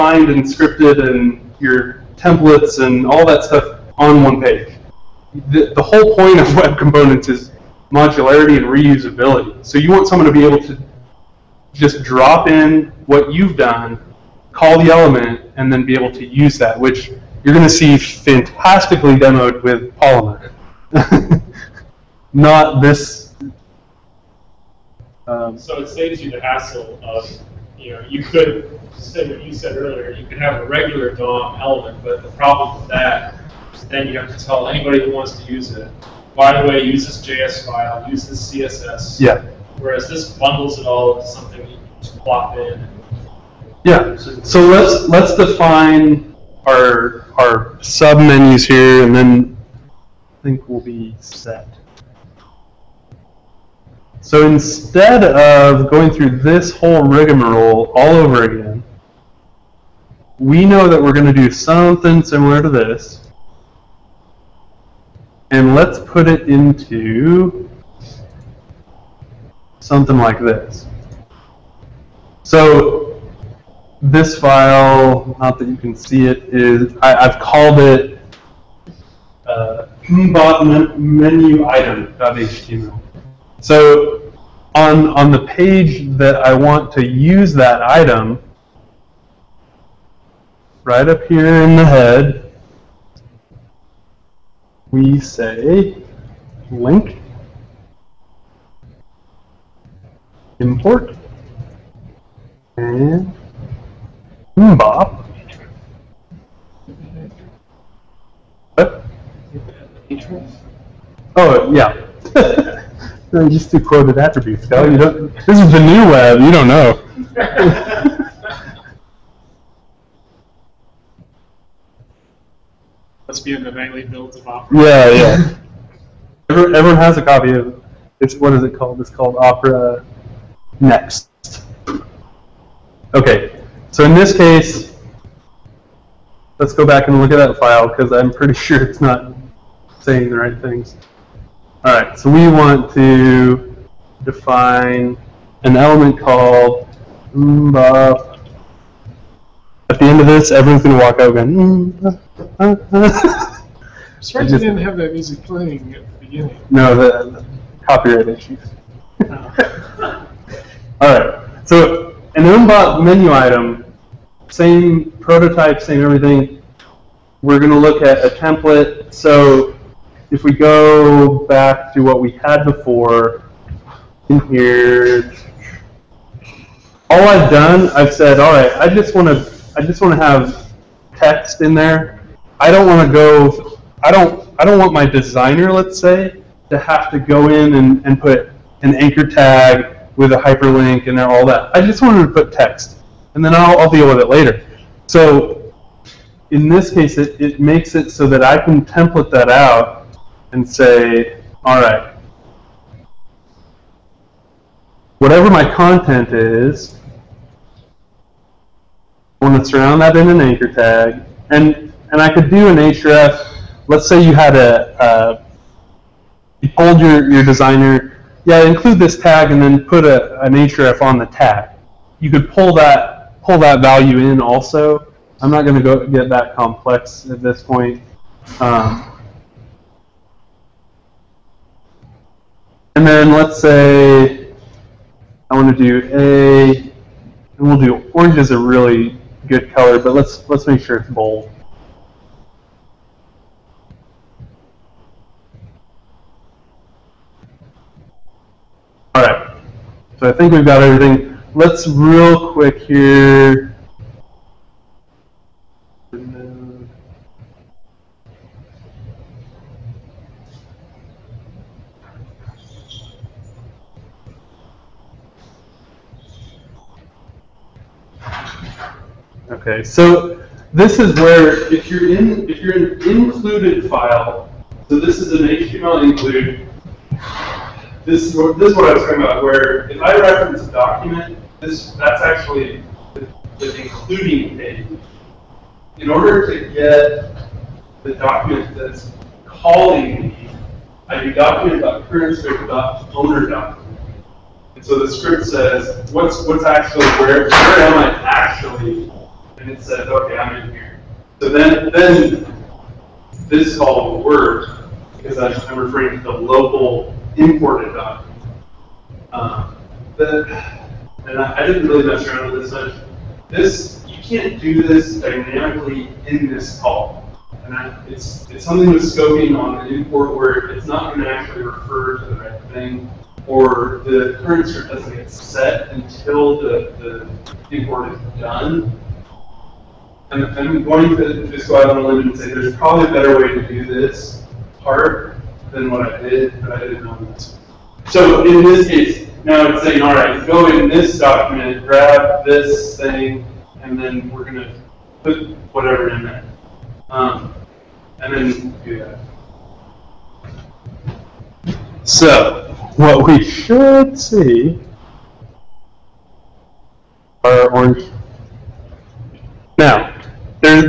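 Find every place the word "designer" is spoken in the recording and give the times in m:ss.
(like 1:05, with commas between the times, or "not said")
3:05, 3:37.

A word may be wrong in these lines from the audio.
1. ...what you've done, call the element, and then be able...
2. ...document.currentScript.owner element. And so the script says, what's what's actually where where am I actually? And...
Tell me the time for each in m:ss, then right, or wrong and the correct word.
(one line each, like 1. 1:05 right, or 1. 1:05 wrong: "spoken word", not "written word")
1. 0:13 right
2. 4:51 wrong: "document", not "element".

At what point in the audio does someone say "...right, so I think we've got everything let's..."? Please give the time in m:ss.
4:09.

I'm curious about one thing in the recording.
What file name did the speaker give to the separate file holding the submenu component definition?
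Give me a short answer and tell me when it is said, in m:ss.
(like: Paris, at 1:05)
menu item.html, at 1:20.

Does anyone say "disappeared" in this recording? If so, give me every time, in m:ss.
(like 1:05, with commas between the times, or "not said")
not said.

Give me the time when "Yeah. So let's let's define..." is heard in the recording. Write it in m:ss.
0:43.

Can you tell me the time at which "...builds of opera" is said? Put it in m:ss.
2:04.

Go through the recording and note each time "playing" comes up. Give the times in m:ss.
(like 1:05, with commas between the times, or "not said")
2:35.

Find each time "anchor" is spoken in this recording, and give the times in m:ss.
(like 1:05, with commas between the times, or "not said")
3:08, 3:30.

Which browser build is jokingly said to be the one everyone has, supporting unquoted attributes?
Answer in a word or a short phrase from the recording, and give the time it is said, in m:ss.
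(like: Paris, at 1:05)
Opera Next, at 2:09.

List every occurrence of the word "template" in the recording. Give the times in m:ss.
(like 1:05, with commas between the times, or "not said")
0:02, 2:48, 3:18.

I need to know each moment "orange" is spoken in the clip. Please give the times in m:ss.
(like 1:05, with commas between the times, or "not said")
3:58, 5:57.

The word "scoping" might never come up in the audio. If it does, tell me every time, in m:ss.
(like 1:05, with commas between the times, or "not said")
5:19.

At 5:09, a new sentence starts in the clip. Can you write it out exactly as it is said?
Um, but, and I, I, didn't really mess around with this much.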